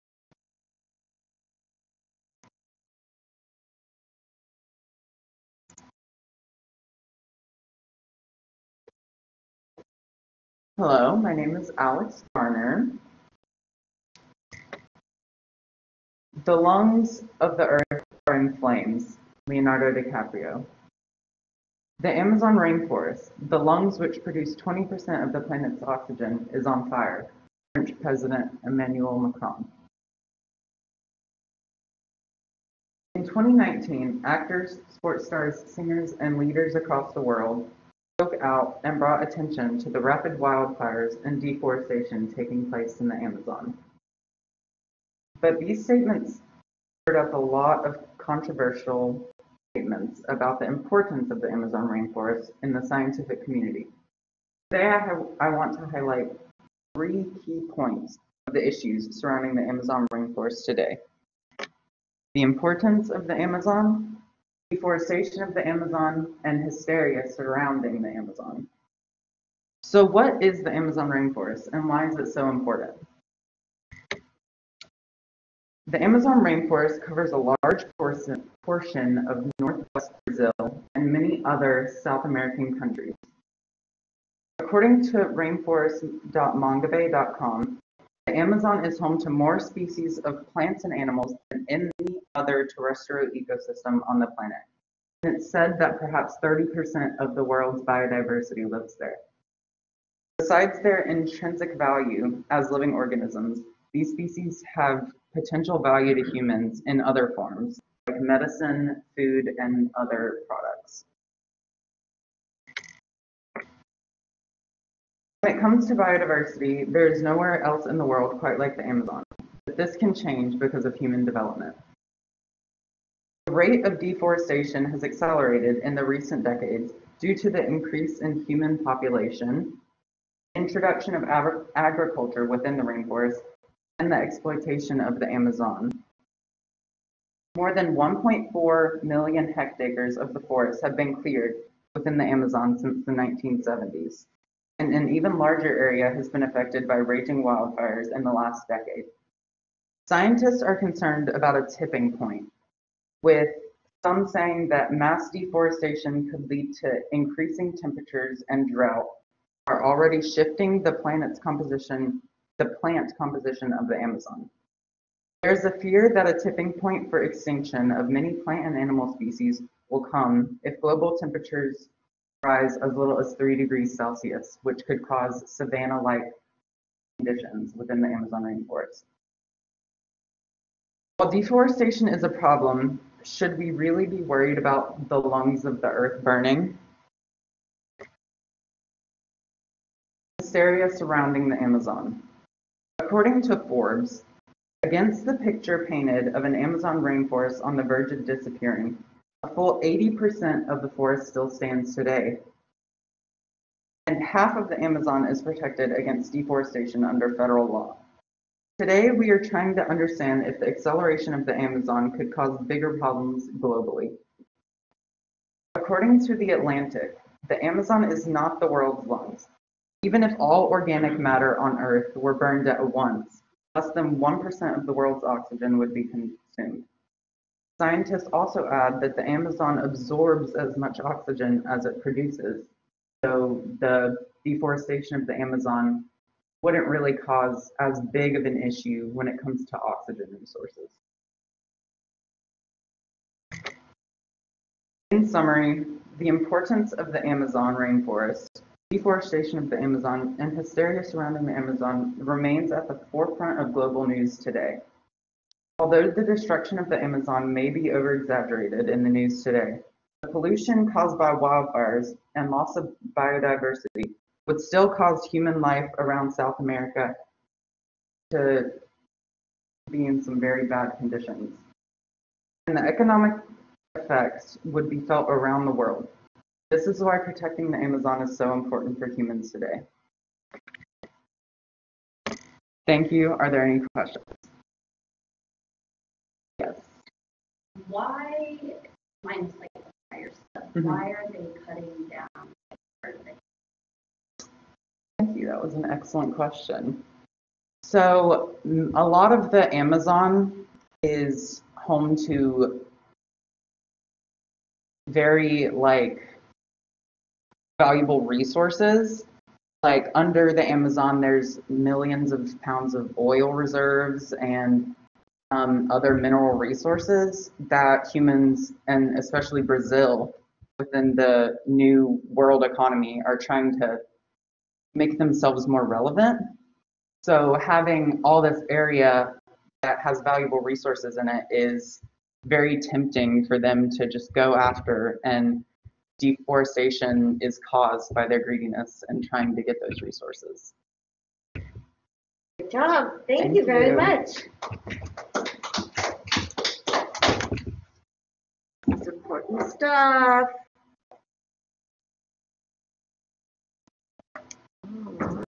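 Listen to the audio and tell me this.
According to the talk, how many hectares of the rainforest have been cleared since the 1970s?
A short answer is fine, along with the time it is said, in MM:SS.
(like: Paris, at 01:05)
1.4 million hectares, at 02:17.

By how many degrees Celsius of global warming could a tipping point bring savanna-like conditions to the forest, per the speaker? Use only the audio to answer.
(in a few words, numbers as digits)
3 degrees Celsius.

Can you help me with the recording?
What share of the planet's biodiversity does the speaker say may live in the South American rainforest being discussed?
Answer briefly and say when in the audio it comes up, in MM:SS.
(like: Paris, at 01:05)
30%, at 01:36.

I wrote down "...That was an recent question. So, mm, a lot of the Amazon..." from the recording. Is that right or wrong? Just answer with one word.
wrong.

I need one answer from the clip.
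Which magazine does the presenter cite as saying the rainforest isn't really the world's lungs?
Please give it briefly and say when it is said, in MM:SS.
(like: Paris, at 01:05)
The Atlantic, at 03:36.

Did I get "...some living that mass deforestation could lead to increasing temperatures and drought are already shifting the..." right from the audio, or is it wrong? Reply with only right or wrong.
wrong.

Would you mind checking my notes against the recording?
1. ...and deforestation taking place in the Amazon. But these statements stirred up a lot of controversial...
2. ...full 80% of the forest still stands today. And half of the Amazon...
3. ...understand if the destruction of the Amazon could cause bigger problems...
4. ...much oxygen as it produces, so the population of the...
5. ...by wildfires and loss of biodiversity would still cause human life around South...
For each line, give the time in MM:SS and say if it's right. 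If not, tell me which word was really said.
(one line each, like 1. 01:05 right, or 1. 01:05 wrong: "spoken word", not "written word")
1. 00:41 right
2. 03:19 right
3. 03:29 wrong: "acceleration", not "destruction"
4. 03:50 wrong: "deforestation", not "population"
5. 04:21 right.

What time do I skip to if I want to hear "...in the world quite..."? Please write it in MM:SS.
01:57.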